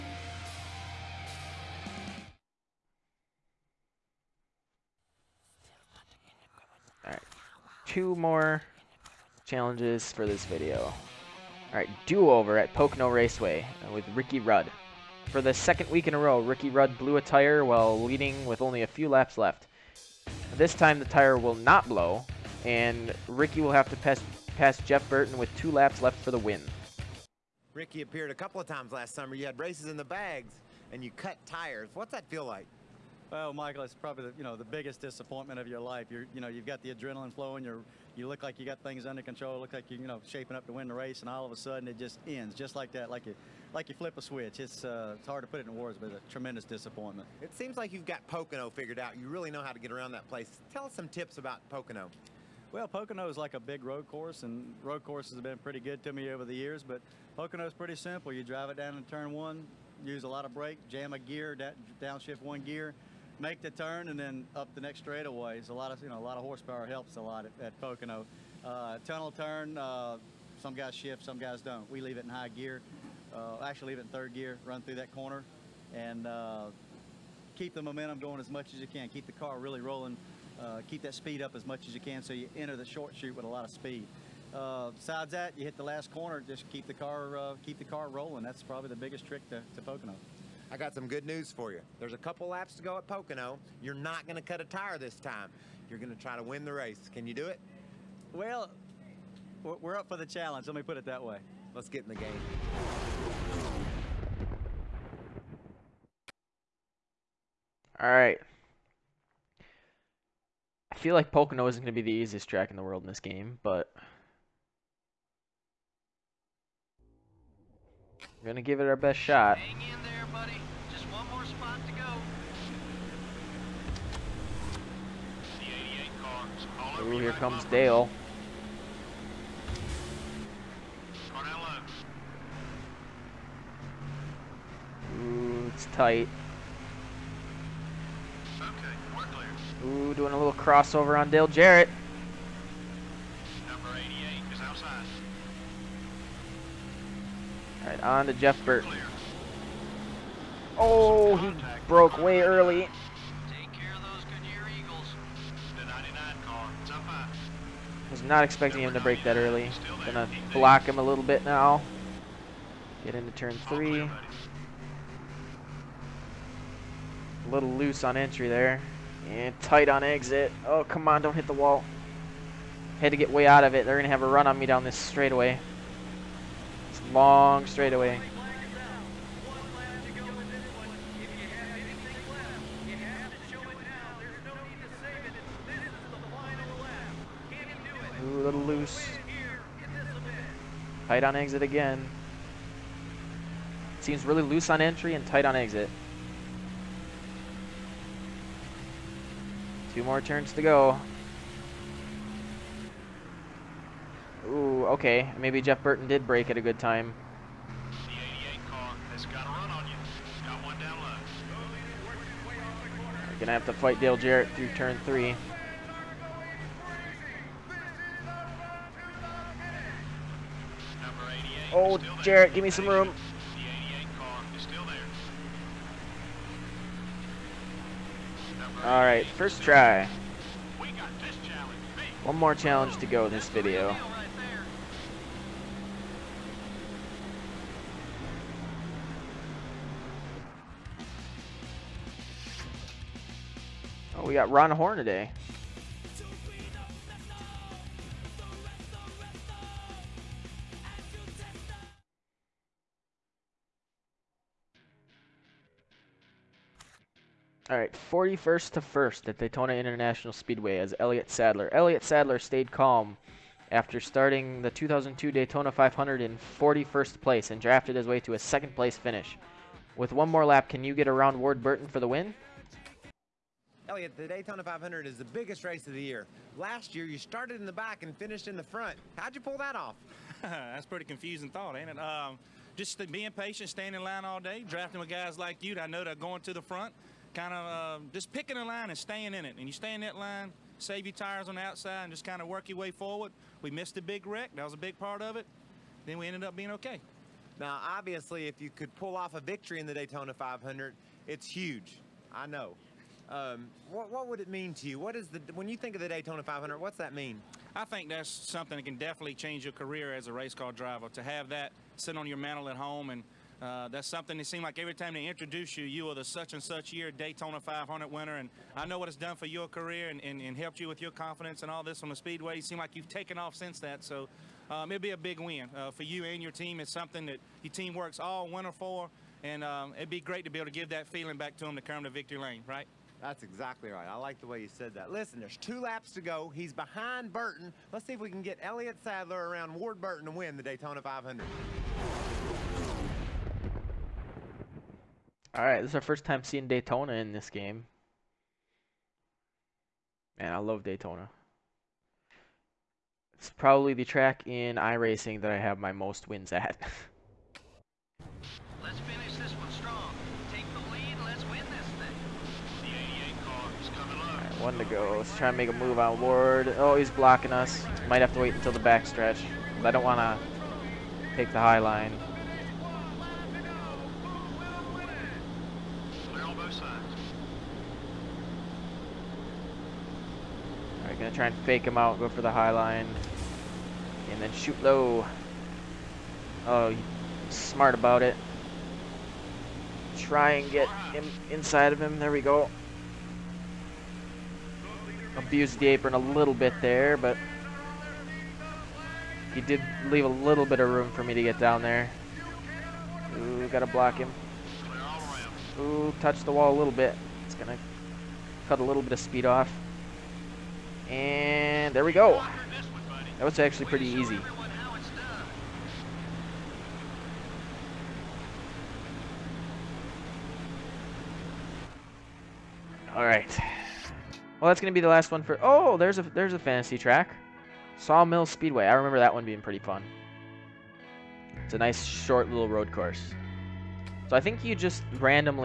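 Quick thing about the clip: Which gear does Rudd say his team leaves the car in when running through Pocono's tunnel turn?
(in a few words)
Third gear.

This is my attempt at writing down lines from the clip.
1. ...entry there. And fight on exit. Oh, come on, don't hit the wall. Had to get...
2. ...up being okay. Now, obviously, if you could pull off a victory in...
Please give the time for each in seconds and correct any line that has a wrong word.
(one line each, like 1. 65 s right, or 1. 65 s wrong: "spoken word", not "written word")
1. 168 s wrong: "tight", not "fight"
2. 296 s right.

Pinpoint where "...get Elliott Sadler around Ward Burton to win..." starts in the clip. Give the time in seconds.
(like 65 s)
338 s.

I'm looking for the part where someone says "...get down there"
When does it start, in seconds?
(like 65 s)
401 s.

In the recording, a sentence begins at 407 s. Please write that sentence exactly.
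It's gonna cut a little bit of speed off.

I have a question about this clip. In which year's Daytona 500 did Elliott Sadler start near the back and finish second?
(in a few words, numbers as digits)
2002.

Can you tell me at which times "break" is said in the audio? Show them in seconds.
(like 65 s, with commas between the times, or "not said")
159 s, 206 s.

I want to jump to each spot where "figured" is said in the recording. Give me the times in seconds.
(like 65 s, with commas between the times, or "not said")
48 s.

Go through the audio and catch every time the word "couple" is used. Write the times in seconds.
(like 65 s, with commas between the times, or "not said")
28 s, 92 s.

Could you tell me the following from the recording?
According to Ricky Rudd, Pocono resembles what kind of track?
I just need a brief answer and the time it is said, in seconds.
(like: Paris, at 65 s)
A big road course, at 53 s.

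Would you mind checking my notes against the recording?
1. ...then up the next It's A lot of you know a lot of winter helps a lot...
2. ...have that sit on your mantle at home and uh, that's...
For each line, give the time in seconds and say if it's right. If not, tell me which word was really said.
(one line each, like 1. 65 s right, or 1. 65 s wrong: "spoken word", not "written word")
1. 64 s wrong: "horsepower", not "winter"
2. 311 s right.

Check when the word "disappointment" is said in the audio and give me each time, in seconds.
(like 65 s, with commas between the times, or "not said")
35 s, 46 s.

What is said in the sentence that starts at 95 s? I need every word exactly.
You're going to try to win the race.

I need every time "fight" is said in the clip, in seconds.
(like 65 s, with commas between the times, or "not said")
213 s.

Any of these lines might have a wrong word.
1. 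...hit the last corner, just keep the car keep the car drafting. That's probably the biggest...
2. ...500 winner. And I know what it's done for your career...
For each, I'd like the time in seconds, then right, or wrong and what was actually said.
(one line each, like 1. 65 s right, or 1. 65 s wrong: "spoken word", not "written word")
1. 85 s wrong: "rolling", not "drafting"
2. 317 s right.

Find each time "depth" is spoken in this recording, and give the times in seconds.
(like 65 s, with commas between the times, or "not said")
not said.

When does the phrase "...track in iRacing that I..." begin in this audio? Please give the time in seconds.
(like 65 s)
354 s.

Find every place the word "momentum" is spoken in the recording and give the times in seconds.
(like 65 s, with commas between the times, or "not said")
77 s.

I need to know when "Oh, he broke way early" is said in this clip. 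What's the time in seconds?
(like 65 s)
150 s.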